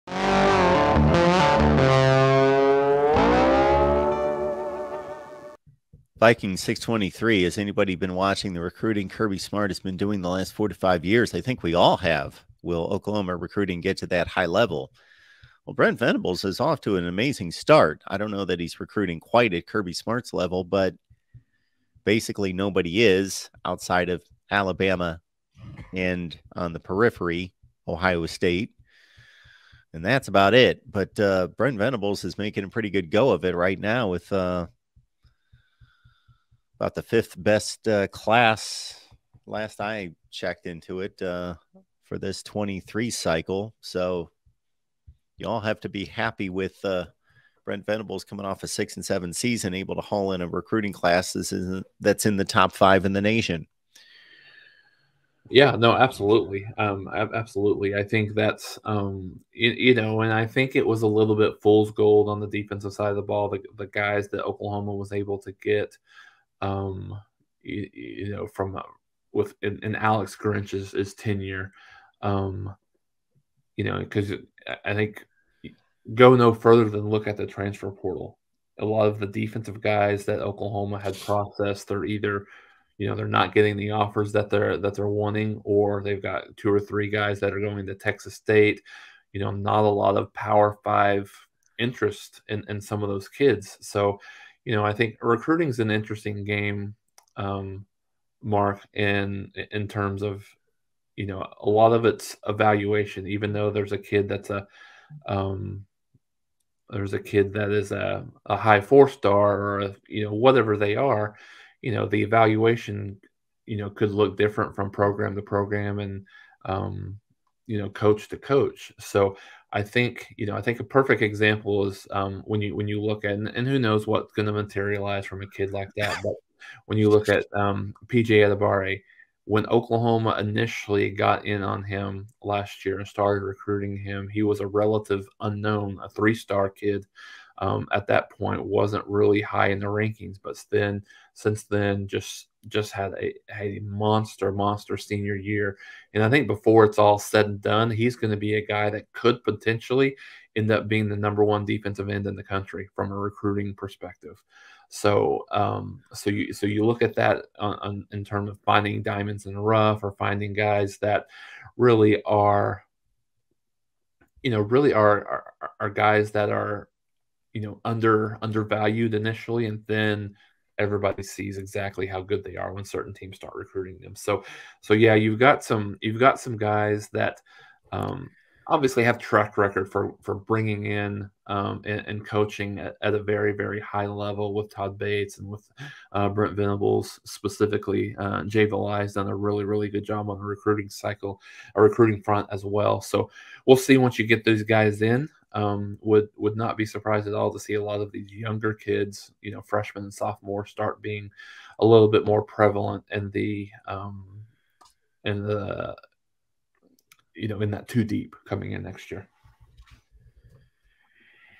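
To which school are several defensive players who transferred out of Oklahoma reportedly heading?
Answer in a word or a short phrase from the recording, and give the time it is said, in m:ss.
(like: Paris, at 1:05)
Texas State, at 1:27.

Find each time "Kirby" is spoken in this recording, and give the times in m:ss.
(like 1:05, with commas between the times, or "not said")
0:09, 0:19.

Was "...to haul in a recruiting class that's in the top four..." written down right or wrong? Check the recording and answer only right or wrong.
wrong.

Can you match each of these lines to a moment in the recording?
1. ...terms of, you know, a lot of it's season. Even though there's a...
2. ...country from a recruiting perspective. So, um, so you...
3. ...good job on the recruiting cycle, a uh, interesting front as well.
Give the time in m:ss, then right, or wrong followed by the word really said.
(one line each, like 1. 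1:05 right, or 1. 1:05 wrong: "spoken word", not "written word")
1. 1:39 wrong: "evaluation", not "season"
2. 2:32 right
3. 3:09 wrong: "recruiting", not "interesting".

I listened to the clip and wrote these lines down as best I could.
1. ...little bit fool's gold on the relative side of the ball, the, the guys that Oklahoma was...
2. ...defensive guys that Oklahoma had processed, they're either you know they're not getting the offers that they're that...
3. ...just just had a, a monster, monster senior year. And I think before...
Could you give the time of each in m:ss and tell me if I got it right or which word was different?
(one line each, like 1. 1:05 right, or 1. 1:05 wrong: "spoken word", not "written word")
1. 1:01 wrong: "defensive", not "relative"
2. 1:19 right
3. 2:22 right.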